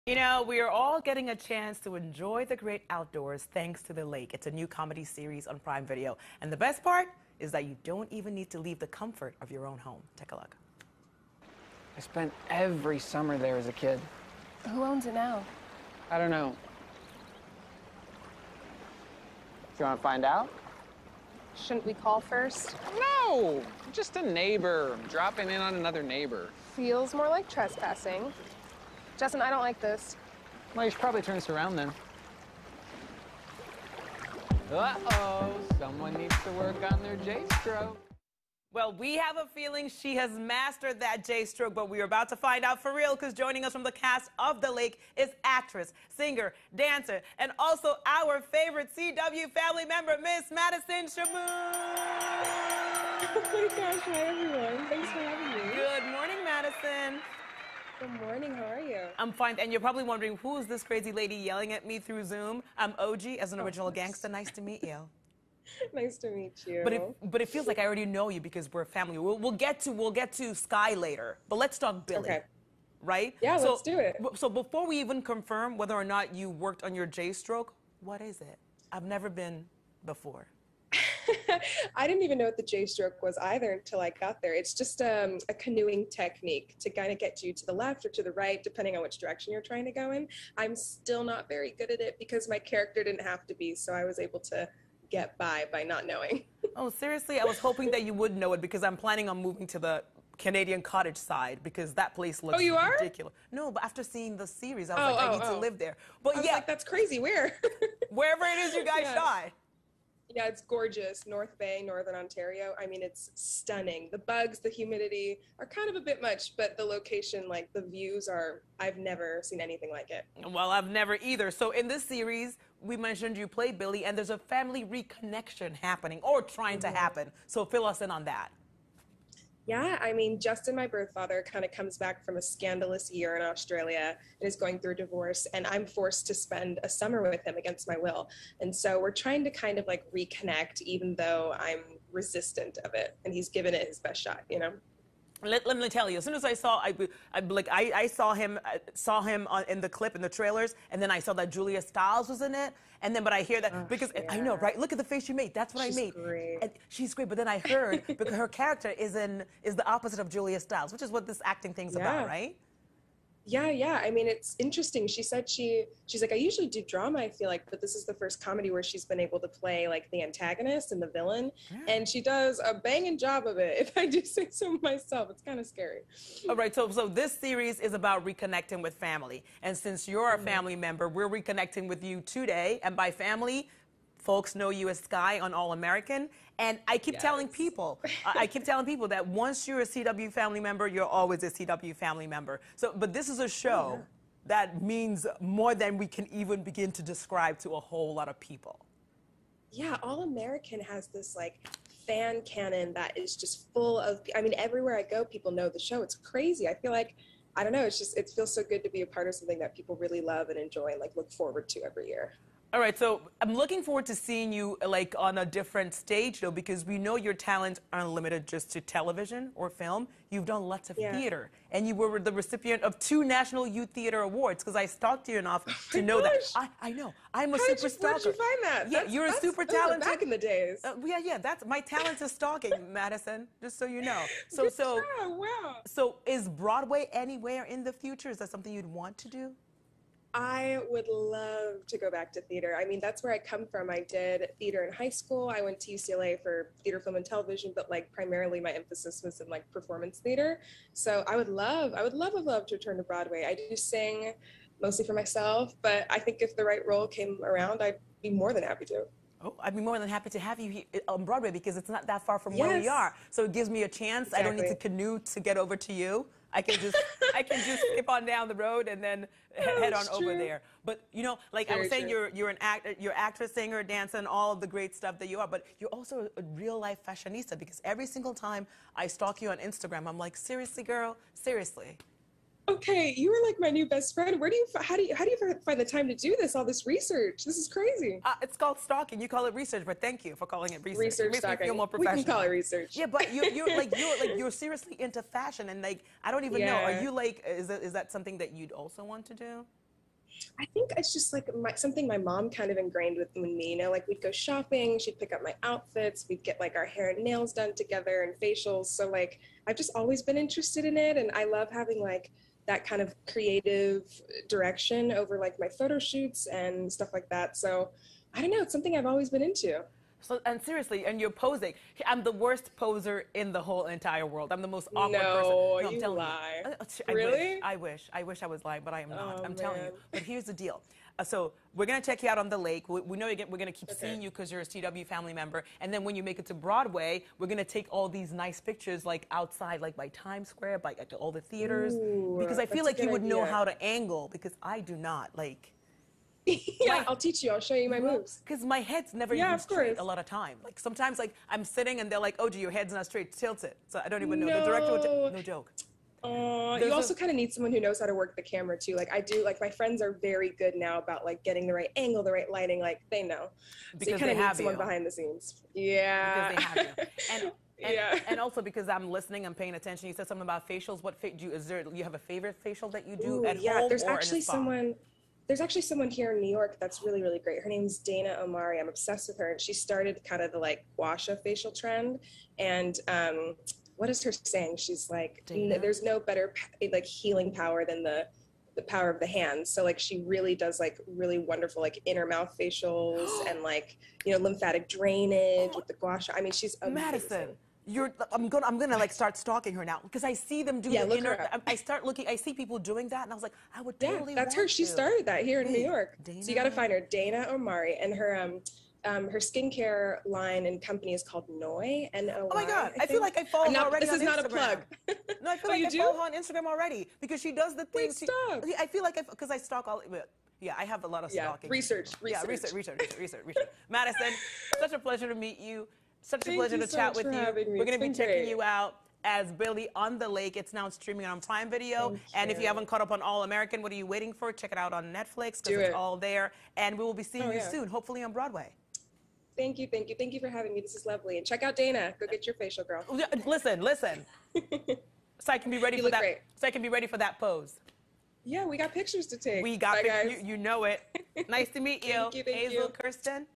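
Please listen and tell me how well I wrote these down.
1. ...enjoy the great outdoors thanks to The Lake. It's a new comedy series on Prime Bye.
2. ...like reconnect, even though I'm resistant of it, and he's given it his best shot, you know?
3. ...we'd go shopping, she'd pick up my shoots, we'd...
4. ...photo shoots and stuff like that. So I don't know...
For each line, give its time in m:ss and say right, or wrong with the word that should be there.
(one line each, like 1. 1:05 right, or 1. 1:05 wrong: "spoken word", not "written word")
1. 0:01 wrong: "Video", not "Bye"
2. 2:19 right
3. 5:04 wrong: "outfits", not "shoots"
4. 5:15 right.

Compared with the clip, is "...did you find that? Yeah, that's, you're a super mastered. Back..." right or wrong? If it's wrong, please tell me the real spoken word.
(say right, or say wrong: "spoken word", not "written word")
wrong: "talented", not "mastered".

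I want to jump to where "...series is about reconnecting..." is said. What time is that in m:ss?
2:57.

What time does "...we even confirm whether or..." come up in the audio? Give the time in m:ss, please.
1:14.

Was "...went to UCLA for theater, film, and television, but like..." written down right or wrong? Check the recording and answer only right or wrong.
right.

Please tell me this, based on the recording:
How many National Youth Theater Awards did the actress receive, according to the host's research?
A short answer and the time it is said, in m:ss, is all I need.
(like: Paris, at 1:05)
2, at 3:42.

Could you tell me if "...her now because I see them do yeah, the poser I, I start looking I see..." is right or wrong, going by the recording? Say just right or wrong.
wrong.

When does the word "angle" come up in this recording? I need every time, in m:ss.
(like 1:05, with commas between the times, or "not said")
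5:43, 6:01.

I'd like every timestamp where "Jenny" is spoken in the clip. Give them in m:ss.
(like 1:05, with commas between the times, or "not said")
not said.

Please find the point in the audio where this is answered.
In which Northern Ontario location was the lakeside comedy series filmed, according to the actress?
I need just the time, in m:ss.
1:51.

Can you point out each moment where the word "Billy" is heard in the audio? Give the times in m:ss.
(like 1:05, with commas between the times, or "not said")
1:12, 2:03, 7:09.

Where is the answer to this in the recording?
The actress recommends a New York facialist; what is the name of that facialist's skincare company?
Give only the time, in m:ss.
6:51.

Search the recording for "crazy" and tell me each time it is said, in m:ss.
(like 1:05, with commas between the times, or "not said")
1:00, 1:46, 3:26, 4:47.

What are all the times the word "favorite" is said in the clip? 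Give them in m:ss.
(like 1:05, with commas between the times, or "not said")
0:48, 6:12.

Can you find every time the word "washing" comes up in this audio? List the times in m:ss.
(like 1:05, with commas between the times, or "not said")
not said.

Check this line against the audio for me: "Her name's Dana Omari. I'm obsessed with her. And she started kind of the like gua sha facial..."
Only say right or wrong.
right.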